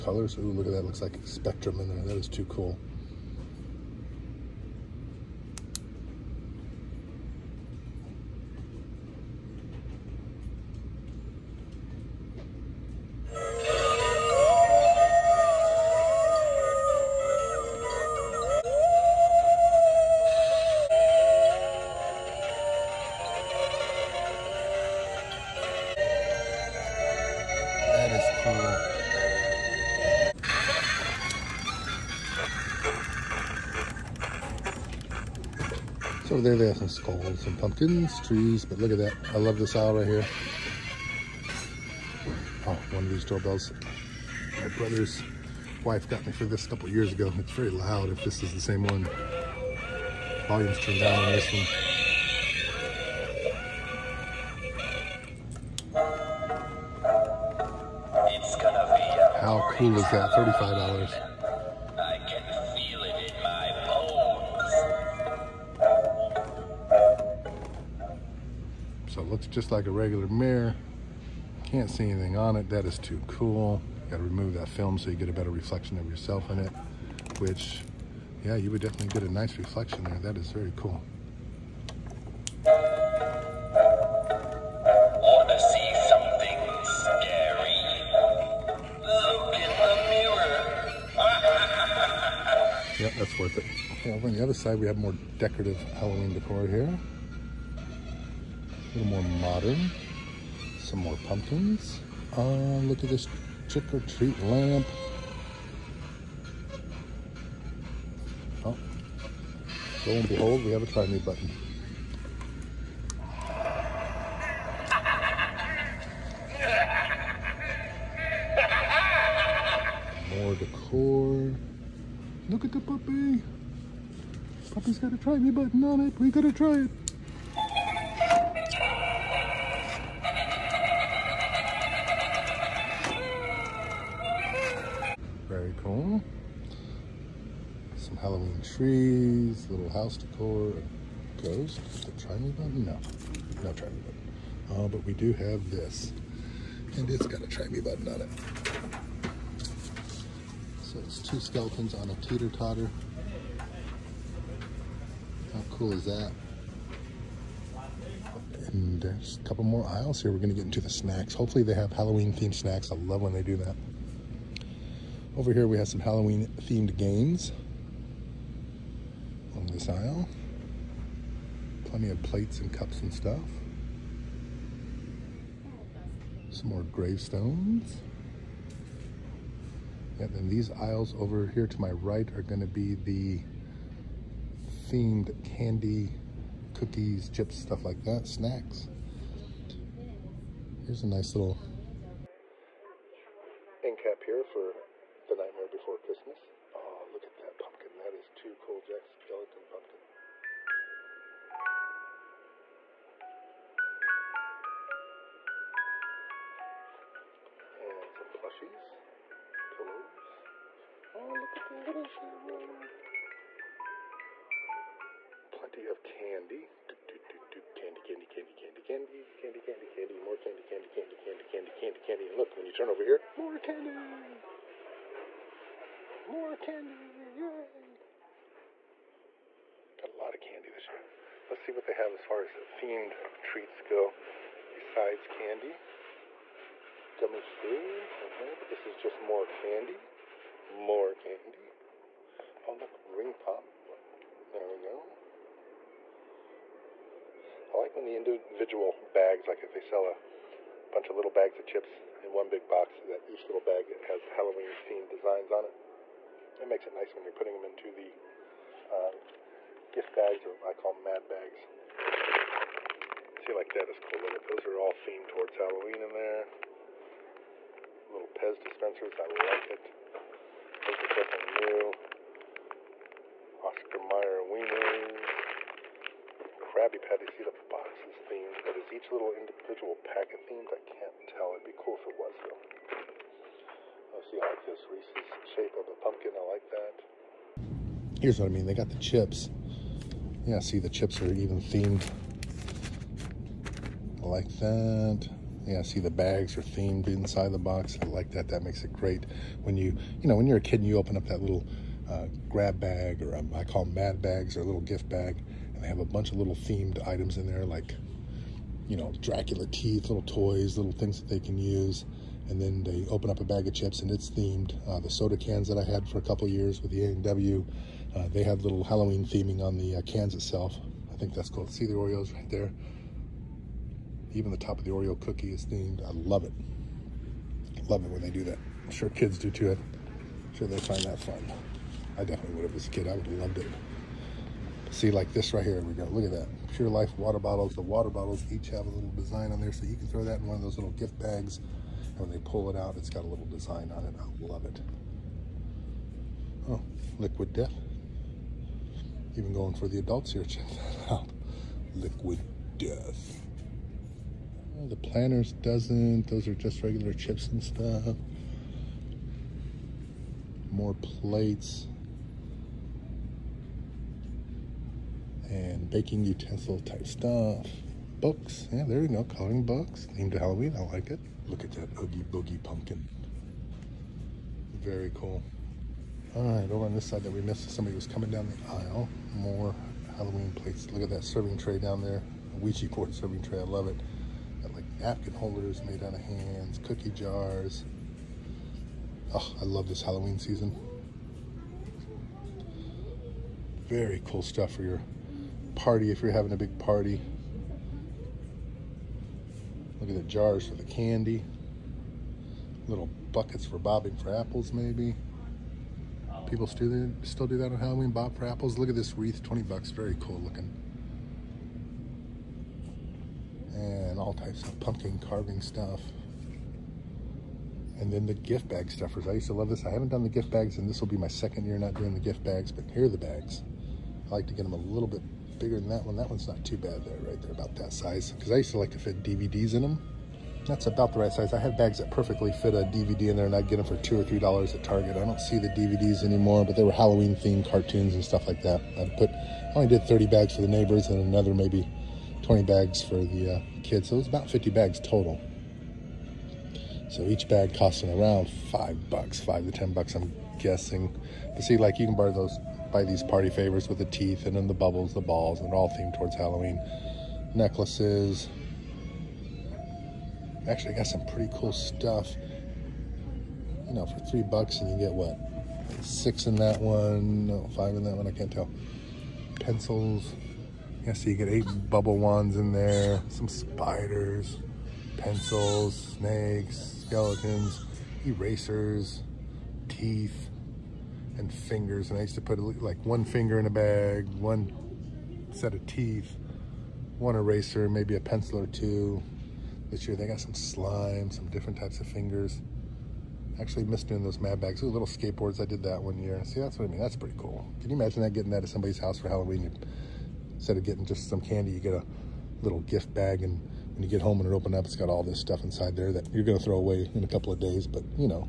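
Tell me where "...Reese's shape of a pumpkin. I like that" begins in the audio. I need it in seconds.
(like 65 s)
284 s.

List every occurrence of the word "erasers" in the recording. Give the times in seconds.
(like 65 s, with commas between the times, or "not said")
478 s, 487 s.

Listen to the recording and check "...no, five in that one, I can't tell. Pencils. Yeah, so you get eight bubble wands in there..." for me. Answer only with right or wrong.
right.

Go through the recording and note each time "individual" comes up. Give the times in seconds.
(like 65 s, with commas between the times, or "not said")
248 s, 279 s.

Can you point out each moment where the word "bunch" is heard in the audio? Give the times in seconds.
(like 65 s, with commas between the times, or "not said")
250 s, 306 s.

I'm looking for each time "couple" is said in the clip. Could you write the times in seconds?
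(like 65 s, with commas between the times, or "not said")
46 s, 159 s, 316 s, 507 s.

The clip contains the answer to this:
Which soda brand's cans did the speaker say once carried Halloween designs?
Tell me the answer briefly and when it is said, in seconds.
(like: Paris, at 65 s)
A&W, at 317 s.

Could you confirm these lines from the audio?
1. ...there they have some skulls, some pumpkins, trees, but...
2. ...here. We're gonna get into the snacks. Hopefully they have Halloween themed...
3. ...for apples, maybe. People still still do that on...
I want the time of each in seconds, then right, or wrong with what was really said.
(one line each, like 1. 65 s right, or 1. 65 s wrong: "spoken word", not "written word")
1. 36 s right
2. 160 s right
3. 404 s right.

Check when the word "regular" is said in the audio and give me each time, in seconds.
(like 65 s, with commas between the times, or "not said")
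69 s, 356 s.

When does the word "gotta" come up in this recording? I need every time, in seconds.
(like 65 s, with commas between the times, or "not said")
74 s, 126 s.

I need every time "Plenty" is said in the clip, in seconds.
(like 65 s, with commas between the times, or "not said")
171 s, 215 s.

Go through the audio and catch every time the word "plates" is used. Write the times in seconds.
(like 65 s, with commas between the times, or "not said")
172 s, 360 s, 380 s.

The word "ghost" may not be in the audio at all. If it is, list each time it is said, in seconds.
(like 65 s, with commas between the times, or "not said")
141 s.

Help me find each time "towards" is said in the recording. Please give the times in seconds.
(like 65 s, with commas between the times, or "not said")
265 s, 456 s.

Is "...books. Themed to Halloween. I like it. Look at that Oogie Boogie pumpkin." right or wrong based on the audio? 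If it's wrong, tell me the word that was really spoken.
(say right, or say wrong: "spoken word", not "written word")
right.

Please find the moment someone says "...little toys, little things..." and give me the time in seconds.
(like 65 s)
310 s.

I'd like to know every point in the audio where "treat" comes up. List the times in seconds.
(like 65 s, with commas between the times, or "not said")
104 s, 233 s.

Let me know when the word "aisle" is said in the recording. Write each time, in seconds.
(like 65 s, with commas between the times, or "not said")
39 s, 159 s, 169 s, 180 s, 378 s.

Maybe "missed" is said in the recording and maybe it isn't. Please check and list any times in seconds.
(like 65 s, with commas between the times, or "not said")
377 s, 493 s.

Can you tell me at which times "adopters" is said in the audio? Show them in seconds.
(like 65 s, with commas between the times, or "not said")
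not said.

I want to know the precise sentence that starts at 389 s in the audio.
Oh, I love this Halloween season.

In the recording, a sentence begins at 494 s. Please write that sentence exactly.
Those little skateboards, I did that one year.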